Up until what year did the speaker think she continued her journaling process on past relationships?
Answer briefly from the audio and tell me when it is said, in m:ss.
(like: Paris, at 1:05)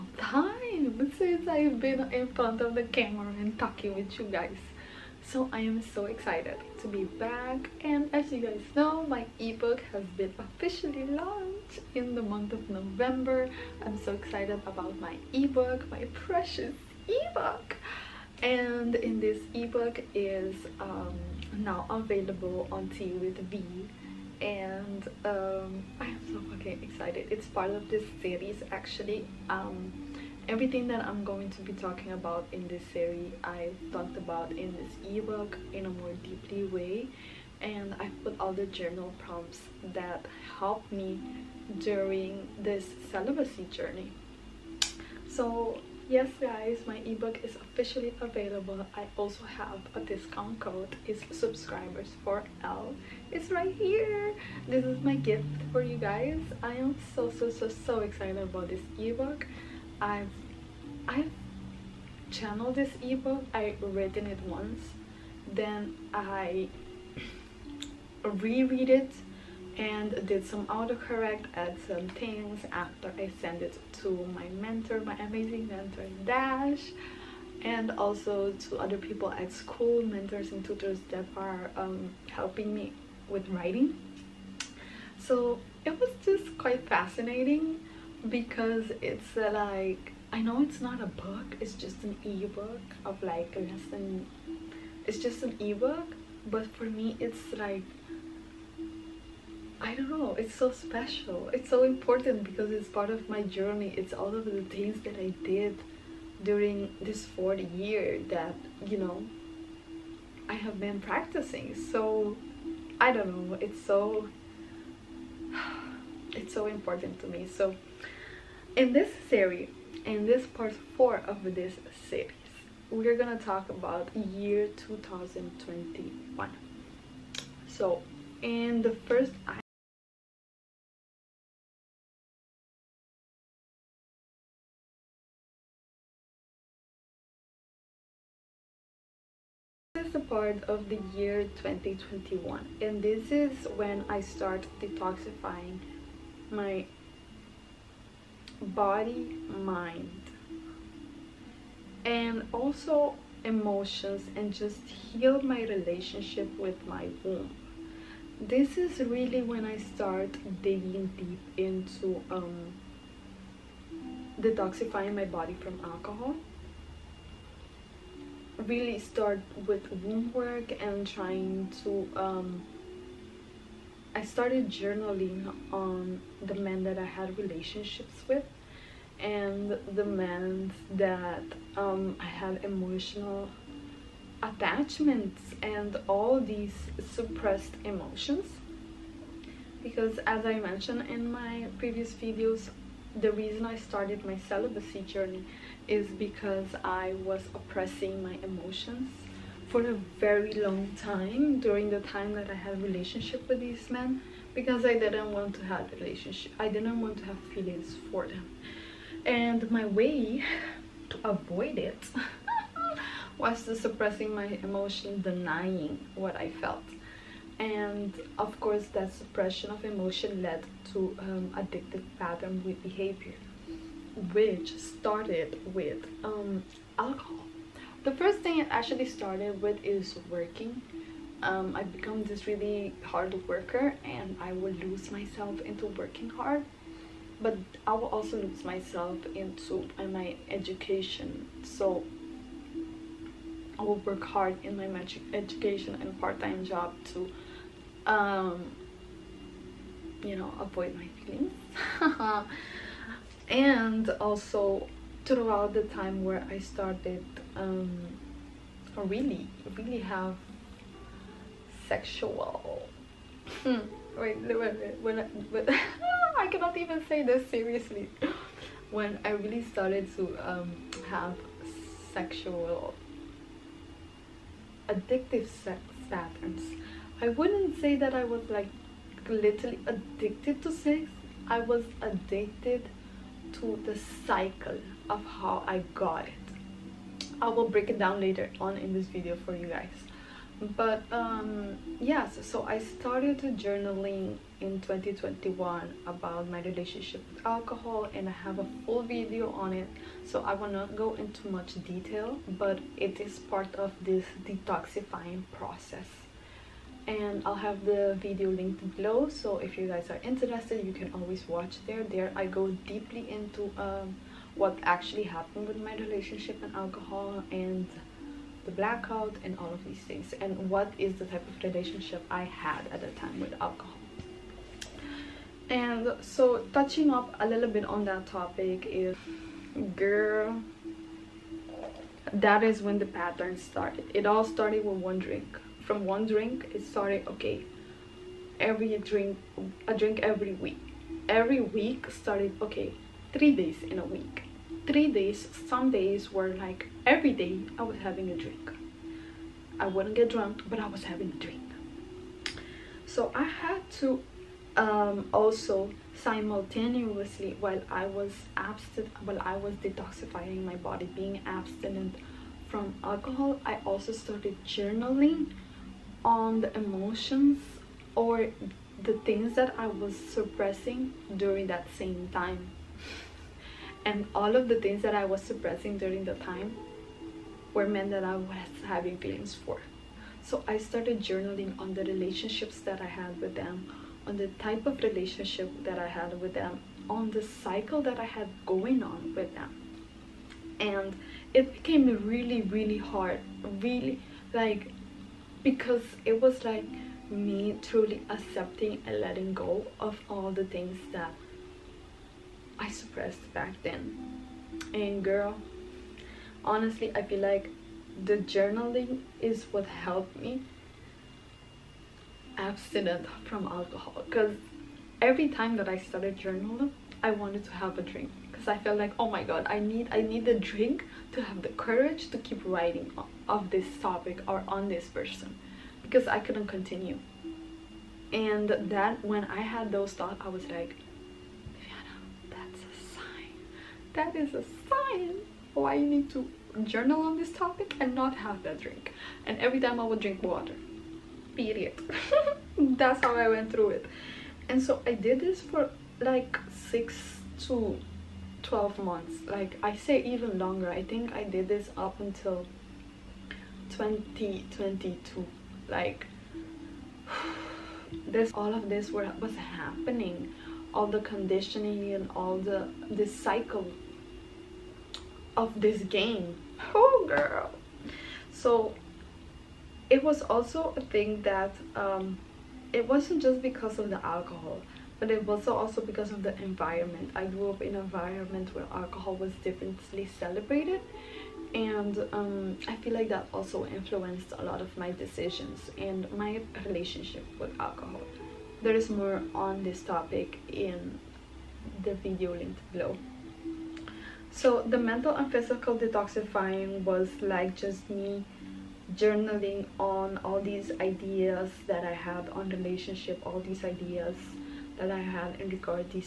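2022, at 7:33.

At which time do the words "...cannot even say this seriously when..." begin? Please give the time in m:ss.
4:26.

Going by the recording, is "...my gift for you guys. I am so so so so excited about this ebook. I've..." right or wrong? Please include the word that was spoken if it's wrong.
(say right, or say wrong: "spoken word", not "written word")
right.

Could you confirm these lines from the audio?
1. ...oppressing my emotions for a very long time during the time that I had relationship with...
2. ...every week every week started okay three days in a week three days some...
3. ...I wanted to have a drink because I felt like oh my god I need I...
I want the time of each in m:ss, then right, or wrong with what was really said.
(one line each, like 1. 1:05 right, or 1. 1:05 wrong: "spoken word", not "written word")
1. 3:17 right
2. 5:40 right
3. 6:57 right.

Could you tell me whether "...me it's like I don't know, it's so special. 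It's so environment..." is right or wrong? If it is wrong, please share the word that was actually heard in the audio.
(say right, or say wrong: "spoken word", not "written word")
wrong: "important", not "environment".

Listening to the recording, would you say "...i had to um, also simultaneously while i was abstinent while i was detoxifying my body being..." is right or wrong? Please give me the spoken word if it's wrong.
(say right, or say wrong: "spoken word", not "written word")
right.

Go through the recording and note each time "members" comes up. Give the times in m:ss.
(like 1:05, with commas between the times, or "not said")
not said.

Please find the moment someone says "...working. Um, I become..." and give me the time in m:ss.
3:50.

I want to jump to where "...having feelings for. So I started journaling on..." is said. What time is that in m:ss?
6:18.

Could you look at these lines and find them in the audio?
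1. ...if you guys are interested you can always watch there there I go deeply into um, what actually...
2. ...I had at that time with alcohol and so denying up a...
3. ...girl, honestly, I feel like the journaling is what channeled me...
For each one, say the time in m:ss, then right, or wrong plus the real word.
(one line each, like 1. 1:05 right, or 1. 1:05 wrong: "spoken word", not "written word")
1. 5:09 right
2. 5:22 wrong: "touching", not "denying"
3. 6:45 wrong: "helped", not "channeled".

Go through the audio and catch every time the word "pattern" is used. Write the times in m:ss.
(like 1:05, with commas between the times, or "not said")
3:42, 4:36, 5:33.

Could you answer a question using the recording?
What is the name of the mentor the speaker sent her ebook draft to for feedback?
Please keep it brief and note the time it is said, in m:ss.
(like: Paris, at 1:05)
Dash, at 1:16.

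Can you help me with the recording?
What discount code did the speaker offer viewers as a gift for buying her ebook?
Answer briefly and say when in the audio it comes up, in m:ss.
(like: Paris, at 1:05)
subscribers for L, at 0:51.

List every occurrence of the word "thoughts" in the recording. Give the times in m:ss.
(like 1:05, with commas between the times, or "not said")
7:10.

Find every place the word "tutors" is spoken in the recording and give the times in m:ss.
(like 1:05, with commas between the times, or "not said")
1:20.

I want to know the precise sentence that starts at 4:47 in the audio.
I will break it down later on in this video for you guys.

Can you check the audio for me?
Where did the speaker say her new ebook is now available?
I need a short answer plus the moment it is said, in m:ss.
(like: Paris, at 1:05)
Tea with Vi, at 0:22.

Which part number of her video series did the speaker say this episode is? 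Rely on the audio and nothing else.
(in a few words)
4.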